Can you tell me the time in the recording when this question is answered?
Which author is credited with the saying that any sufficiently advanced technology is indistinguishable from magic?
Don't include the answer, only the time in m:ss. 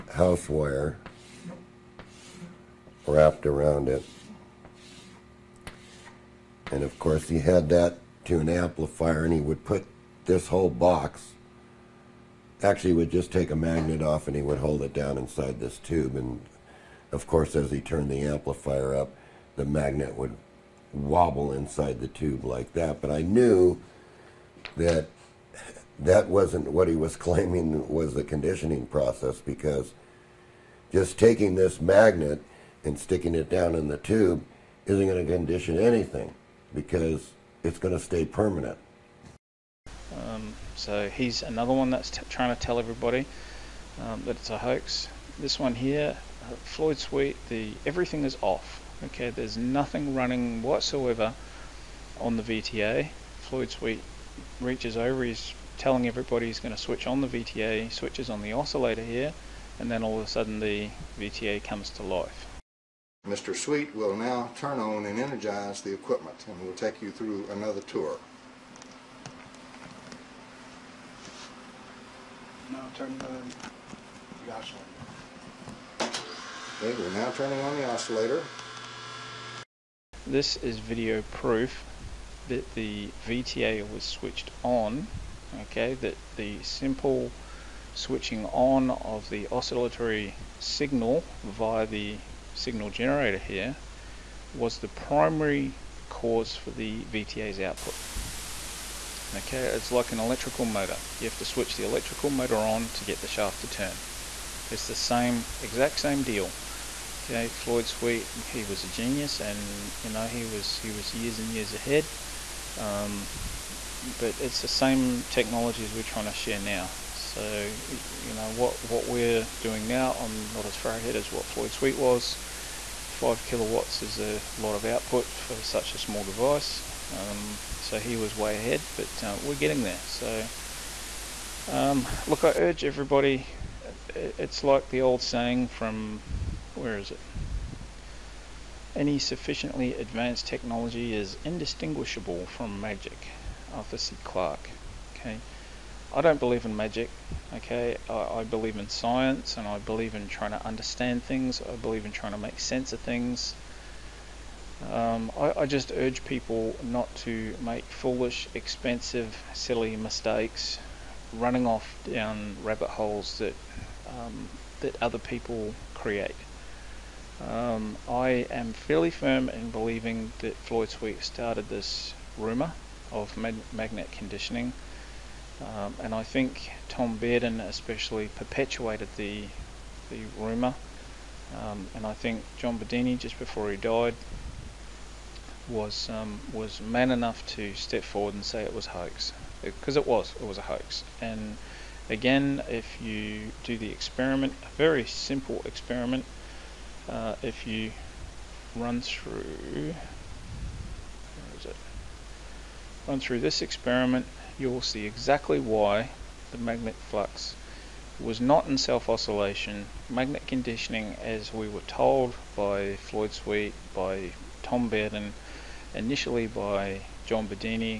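2:23.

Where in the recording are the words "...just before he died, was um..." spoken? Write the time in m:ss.
3:03.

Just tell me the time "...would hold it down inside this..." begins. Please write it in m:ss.
0:14.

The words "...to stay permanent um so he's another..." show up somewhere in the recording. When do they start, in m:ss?
0:37.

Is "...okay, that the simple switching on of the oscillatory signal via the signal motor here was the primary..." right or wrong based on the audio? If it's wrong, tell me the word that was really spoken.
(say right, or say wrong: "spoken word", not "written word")
wrong: "generator", not "motor".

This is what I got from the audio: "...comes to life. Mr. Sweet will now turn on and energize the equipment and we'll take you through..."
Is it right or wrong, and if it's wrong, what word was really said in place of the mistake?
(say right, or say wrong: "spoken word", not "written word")
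right.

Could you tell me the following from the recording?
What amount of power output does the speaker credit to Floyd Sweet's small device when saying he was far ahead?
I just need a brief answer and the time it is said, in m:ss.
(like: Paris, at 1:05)
5 kilowatts, at 2:03.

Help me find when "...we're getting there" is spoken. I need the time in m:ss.
2:09.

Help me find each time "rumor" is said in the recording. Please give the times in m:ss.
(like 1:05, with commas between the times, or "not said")
2:52, 3:00.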